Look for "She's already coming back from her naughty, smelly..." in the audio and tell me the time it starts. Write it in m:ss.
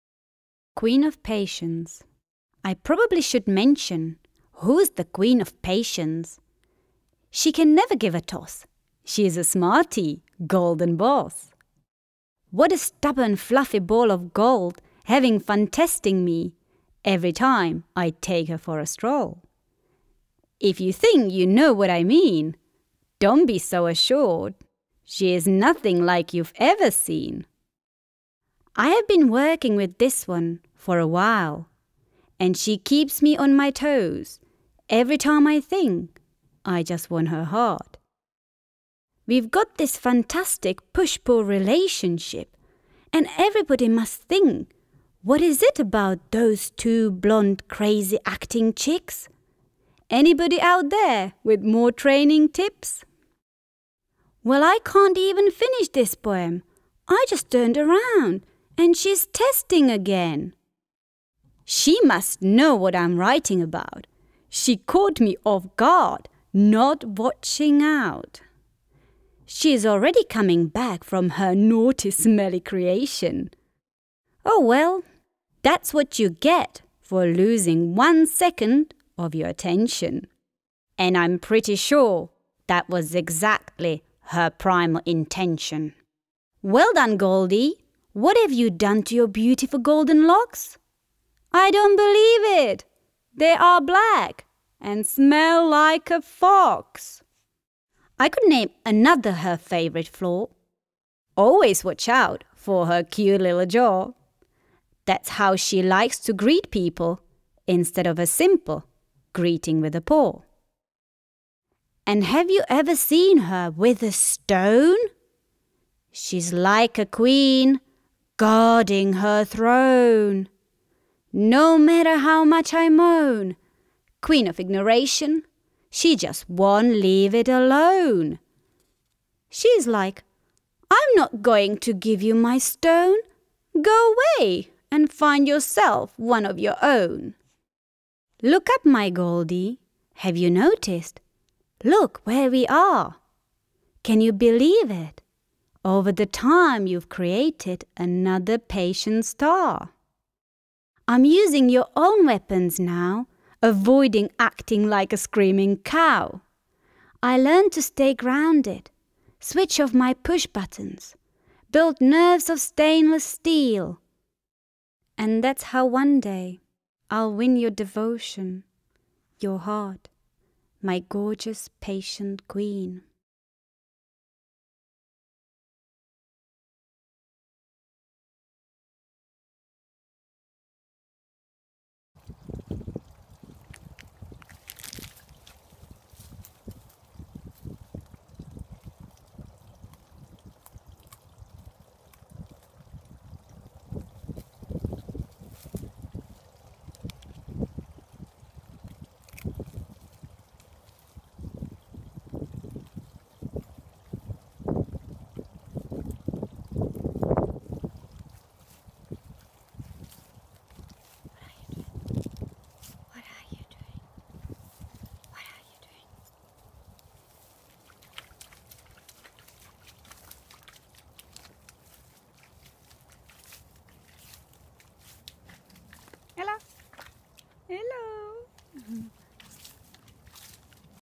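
1:09.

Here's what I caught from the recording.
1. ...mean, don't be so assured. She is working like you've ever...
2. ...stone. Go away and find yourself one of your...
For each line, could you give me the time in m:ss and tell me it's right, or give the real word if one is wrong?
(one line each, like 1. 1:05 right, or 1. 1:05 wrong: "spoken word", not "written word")
1. 0:22 wrong: "nothing", not "working"
2. 2:12 right.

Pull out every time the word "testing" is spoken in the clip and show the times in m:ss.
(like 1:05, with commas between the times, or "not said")
0:15, 0:59.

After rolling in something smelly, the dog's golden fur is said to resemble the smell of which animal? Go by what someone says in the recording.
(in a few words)
A fox.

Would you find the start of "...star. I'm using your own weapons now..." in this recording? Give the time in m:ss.
2:29.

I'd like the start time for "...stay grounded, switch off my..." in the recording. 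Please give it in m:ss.
2:37.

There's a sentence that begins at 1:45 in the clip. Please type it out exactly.
That's how she likes to greet people instead of a simple greeting with a paw.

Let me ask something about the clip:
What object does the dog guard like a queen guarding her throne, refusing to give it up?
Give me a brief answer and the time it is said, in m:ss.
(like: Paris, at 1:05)
A stone, at 1:54.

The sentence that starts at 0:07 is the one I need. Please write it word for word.
She can never give a toss.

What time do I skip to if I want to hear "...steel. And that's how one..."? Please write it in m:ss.
2:43.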